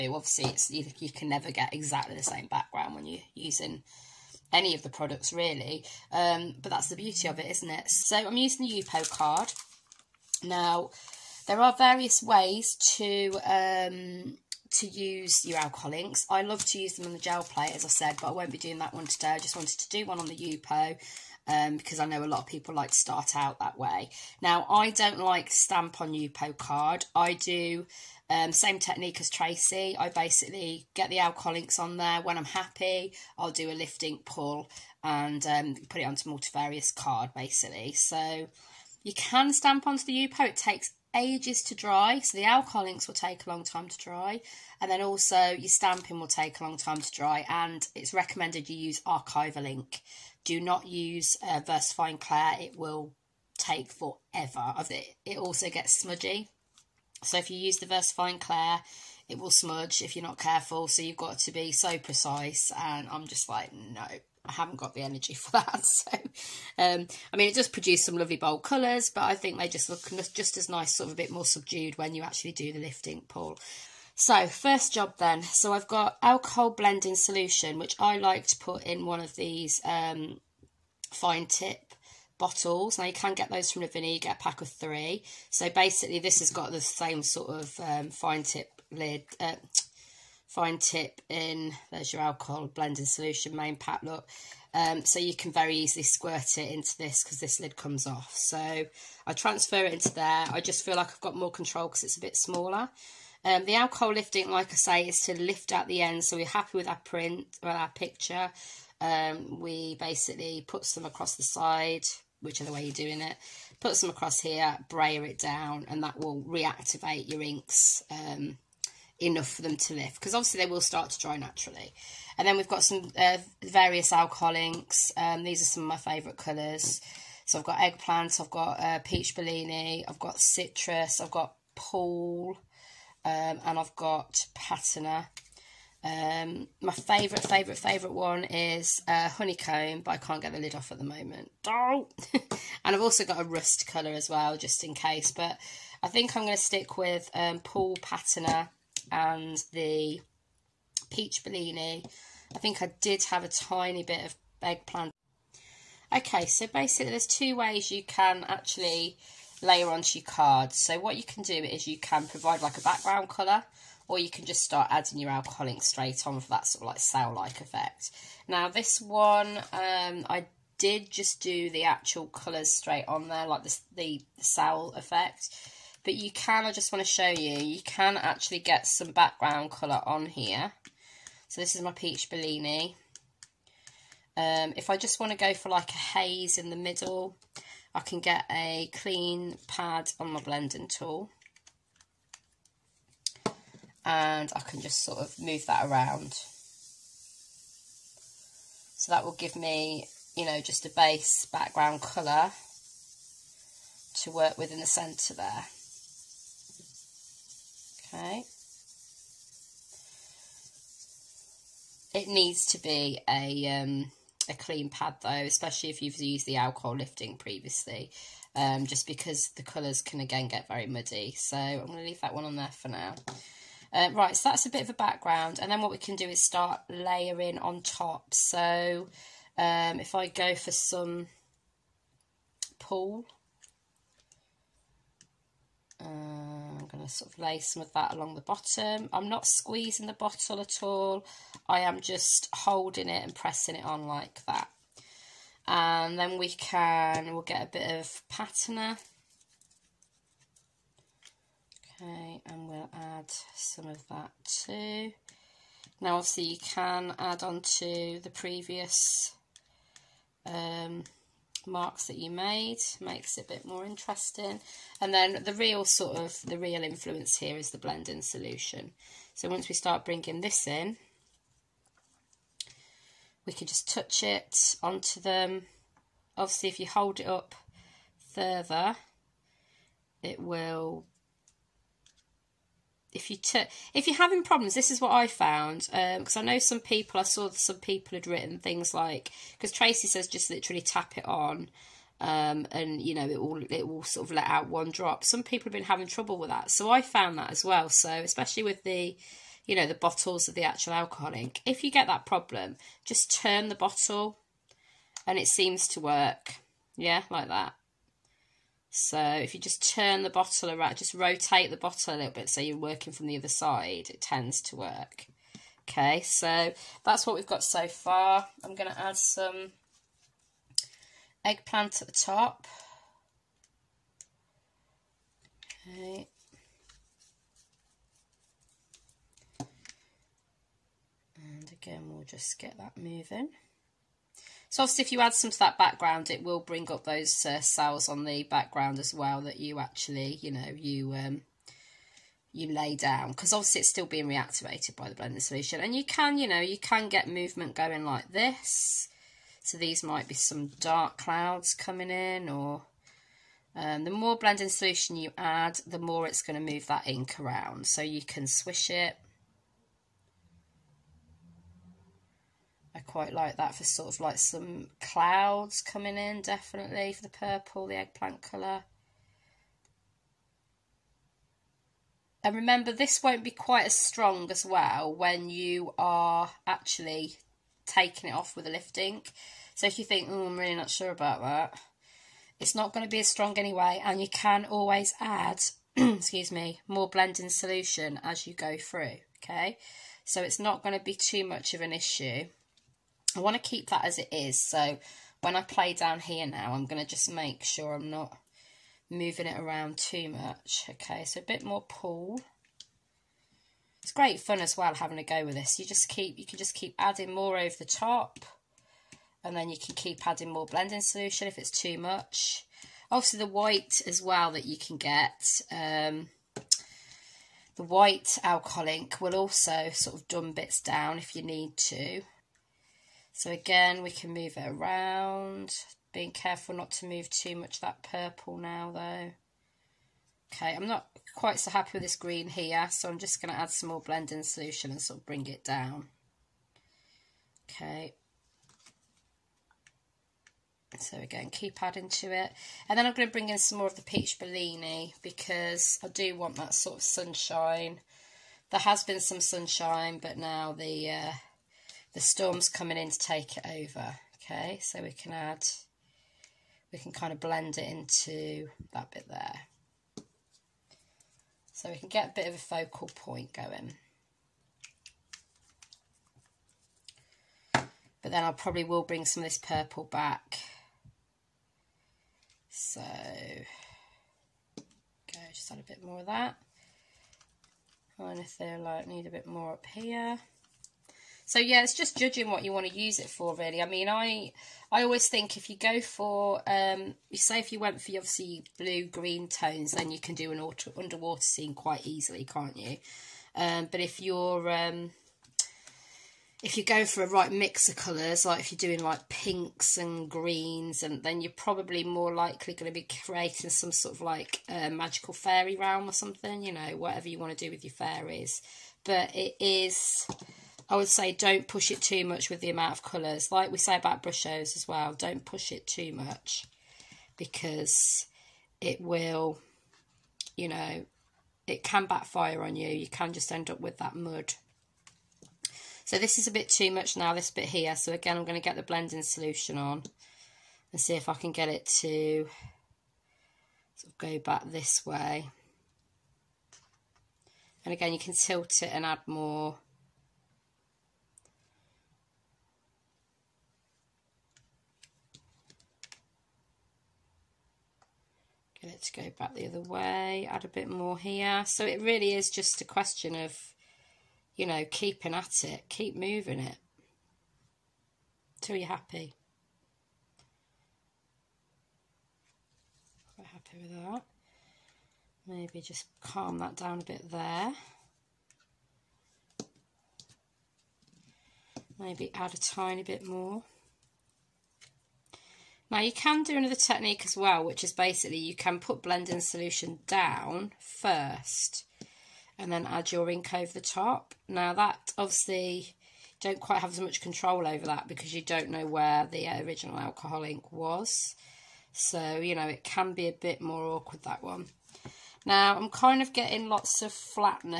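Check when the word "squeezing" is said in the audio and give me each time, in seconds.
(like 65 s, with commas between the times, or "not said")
239 s.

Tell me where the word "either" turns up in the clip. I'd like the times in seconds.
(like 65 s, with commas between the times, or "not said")
not said.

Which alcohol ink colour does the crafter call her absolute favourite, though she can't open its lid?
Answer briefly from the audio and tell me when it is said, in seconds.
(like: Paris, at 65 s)
Honeycomb, at 139 s.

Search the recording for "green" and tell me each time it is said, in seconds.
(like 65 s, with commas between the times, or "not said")
432 s, 489 s, 500 s.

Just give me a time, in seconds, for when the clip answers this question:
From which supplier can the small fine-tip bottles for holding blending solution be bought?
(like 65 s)
83 s.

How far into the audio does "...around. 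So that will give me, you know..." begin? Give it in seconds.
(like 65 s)
195 s.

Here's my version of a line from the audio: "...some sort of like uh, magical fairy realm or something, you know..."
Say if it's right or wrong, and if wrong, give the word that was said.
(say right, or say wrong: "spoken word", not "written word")
right.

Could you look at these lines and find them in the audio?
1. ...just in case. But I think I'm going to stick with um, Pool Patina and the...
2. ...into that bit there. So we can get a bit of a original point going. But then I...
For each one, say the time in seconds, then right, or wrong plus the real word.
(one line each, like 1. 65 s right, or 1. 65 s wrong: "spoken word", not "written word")
1. 144 s right
2. 457 s wrong: "focal", not "original".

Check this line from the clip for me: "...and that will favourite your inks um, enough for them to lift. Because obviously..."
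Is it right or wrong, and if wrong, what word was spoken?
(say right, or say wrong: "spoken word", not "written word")
wrong: "reactivate", not "favourite".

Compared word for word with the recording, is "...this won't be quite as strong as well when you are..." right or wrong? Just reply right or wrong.
right.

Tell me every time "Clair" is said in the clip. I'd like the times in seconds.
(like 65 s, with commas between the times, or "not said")
52 s, 58 s.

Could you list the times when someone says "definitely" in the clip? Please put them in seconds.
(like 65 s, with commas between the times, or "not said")
366 s.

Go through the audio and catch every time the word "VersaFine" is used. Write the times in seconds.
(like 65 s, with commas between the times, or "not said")
51 s, 57 s.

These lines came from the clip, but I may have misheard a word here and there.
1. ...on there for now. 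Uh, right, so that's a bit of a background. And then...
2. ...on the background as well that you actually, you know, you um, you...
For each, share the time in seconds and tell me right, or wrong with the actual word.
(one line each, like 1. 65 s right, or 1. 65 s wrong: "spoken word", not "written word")
1. 222 s right
2. 338 s right.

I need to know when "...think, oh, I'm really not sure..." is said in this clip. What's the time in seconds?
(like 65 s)
380 s.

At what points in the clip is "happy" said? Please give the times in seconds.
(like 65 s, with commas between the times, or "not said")
32 s, 106 s, 431 s, 558 s, 563 s.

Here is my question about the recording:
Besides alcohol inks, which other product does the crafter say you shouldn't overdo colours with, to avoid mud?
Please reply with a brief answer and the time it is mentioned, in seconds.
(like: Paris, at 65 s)
brushos, at 514 s.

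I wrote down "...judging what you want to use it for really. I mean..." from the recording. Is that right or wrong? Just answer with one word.
right.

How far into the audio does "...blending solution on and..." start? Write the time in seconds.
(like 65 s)
528 s.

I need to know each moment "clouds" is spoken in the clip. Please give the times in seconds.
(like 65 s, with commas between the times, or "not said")
351 s, 365 s.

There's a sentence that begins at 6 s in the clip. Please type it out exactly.
Um, but that's the beauty of it, isn't it?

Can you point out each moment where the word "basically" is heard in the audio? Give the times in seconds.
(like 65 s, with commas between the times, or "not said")
30 s, 37 s, 85 s, 109 s, 156 s, 577 s.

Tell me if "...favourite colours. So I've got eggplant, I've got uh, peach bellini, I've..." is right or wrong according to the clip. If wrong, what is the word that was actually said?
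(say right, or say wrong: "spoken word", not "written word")
right.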